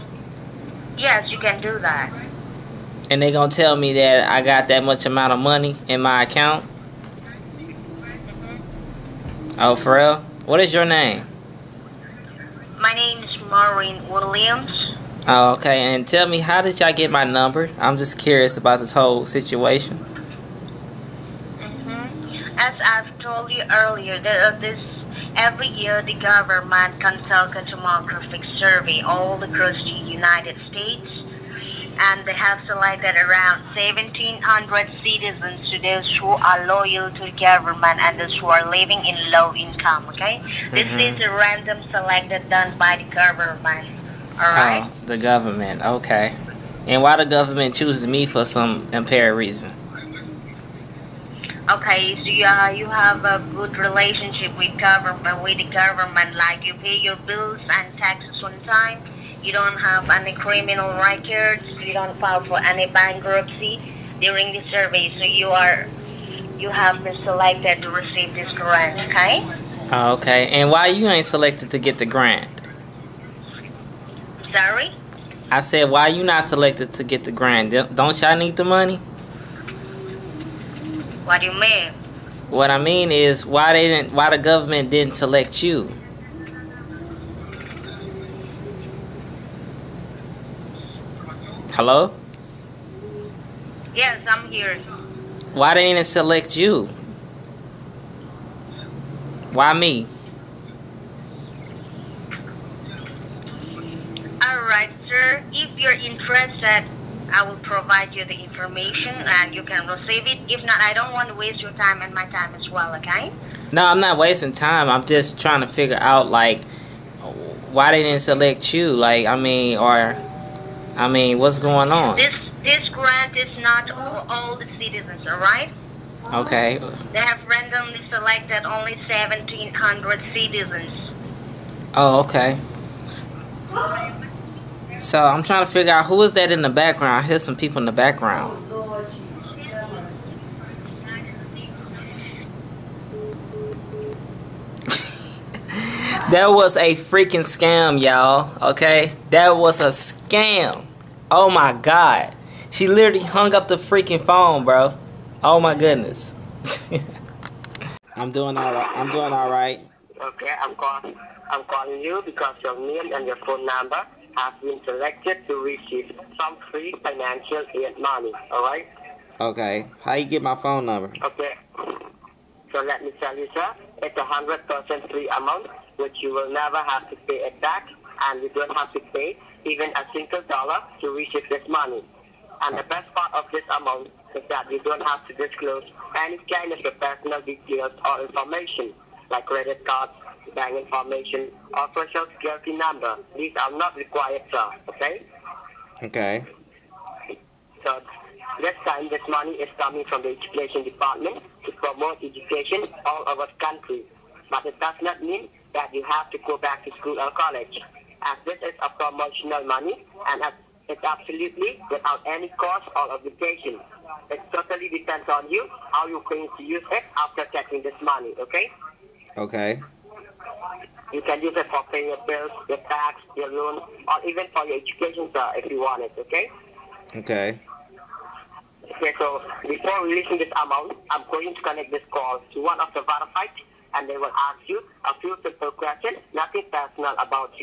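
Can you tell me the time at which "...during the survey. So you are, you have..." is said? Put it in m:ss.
1:04.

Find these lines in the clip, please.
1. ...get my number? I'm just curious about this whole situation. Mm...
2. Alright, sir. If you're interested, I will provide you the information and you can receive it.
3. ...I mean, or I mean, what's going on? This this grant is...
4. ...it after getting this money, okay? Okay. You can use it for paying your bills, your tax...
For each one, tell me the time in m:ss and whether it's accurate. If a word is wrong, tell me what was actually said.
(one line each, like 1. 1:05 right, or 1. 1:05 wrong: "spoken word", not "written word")
1. 0:16 right
2. 1:44 right
3. 1:59 right
4. 3:36 right.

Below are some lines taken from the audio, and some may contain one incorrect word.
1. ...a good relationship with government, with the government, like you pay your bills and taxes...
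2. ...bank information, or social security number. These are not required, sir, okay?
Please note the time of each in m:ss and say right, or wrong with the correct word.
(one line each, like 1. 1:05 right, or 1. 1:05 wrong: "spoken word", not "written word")
1. 0:53 right
2. 3:10 right.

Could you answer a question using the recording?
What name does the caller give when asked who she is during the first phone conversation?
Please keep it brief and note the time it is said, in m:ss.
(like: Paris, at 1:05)
Maureen Williams, at 0:13.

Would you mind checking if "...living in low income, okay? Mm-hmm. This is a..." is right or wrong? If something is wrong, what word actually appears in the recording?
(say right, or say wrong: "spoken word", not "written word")
right.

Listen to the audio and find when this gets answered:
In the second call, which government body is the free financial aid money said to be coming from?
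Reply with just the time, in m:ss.
3:20.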